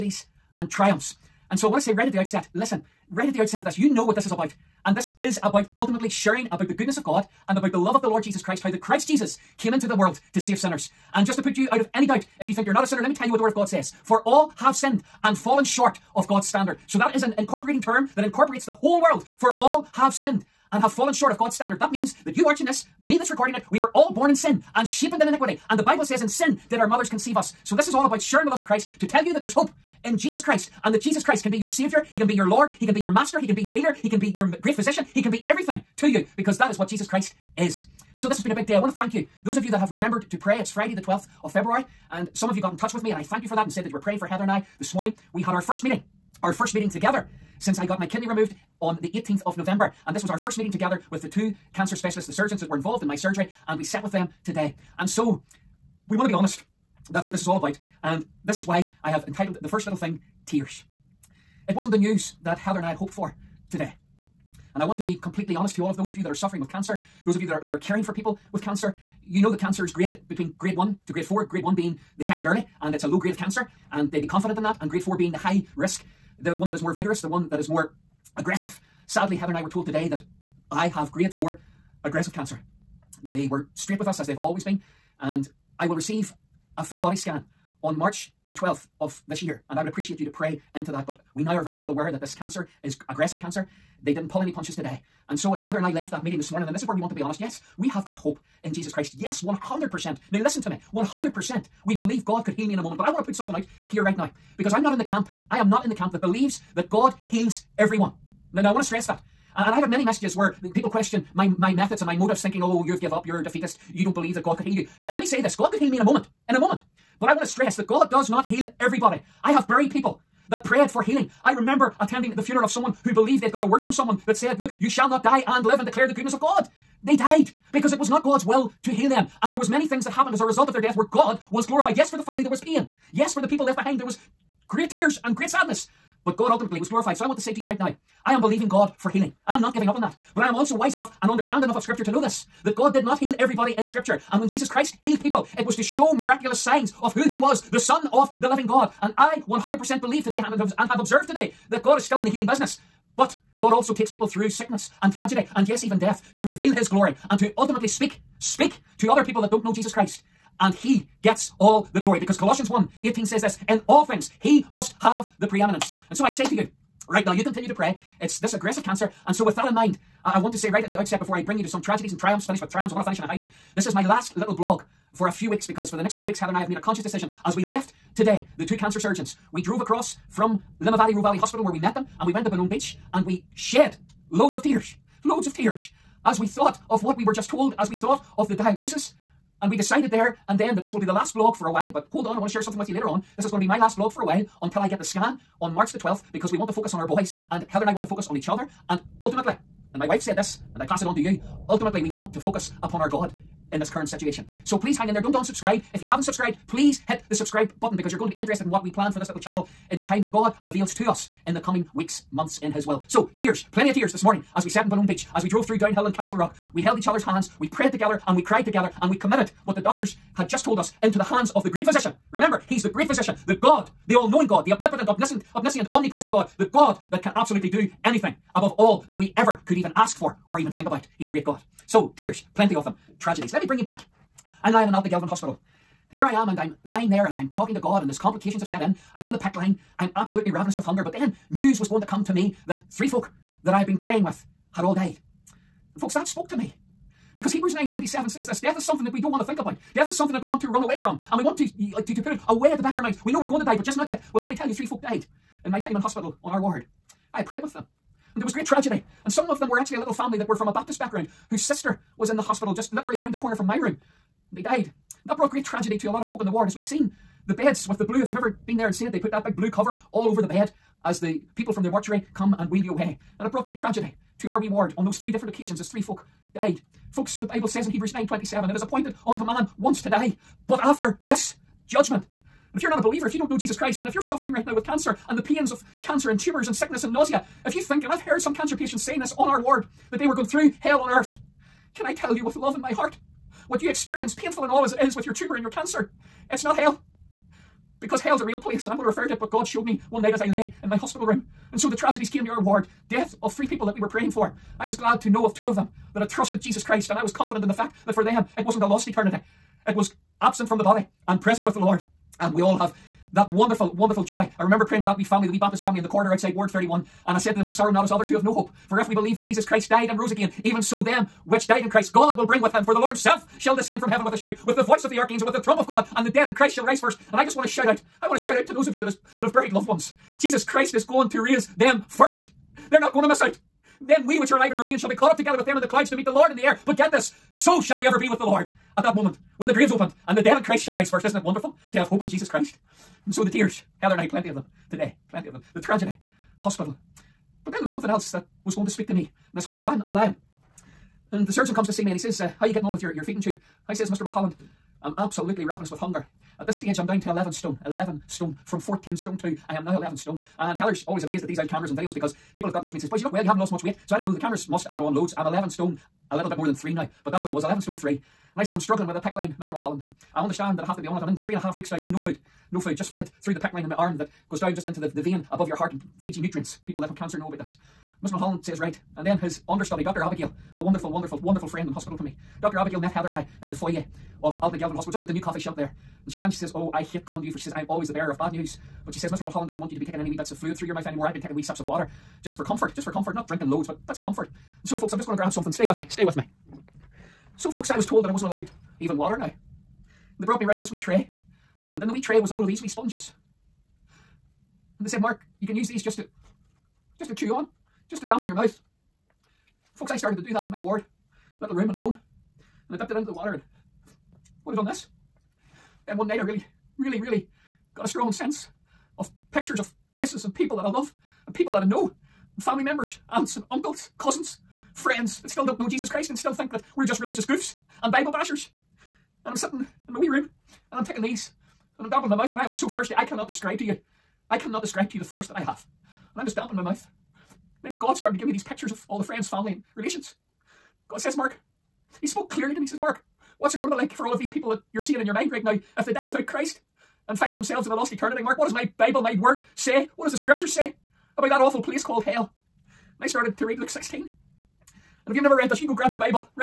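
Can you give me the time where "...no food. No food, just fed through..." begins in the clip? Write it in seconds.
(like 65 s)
372 s.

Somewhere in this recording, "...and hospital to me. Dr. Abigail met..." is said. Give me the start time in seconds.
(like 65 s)
381 s.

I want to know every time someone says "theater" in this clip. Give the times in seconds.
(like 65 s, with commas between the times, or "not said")
not said.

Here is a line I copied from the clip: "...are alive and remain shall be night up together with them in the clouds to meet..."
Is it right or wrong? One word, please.
wrong.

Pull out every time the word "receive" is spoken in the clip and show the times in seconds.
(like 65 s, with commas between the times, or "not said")
85 s.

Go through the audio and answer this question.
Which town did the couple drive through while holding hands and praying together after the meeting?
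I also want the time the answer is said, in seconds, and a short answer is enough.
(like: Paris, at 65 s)
Castlerock, at 216 s.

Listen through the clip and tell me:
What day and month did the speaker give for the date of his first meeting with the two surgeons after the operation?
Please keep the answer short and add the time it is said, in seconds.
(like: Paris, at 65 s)
12th of February, at 40 s.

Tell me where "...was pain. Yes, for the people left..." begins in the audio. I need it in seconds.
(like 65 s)
132 s.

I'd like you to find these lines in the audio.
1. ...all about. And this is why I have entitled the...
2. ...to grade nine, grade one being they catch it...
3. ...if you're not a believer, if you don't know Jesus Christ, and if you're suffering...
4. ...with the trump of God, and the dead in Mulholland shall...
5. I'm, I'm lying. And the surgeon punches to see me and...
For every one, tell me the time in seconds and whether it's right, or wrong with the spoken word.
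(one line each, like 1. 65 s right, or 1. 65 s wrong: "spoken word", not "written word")
1. 57 s right
2. 71 s wrong: "four", not "nine"
3. 282 s right
4. 325 s wrong: "Christ", not "Mulholland"
5. 349 s wrong: "comes", not "punches".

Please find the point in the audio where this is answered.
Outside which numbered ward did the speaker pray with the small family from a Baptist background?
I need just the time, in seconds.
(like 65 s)
316 s.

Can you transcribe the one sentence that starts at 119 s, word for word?
I have buried people that prayed for healing.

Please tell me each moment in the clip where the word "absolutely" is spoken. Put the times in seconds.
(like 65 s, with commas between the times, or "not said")
227 s, 240 s, 355 s.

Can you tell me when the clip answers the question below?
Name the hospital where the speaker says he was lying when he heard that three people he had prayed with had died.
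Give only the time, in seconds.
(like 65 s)
234 s.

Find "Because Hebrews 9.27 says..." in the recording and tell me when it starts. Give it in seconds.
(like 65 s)
247 s.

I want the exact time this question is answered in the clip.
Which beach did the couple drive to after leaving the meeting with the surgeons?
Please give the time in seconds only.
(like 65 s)
182 s.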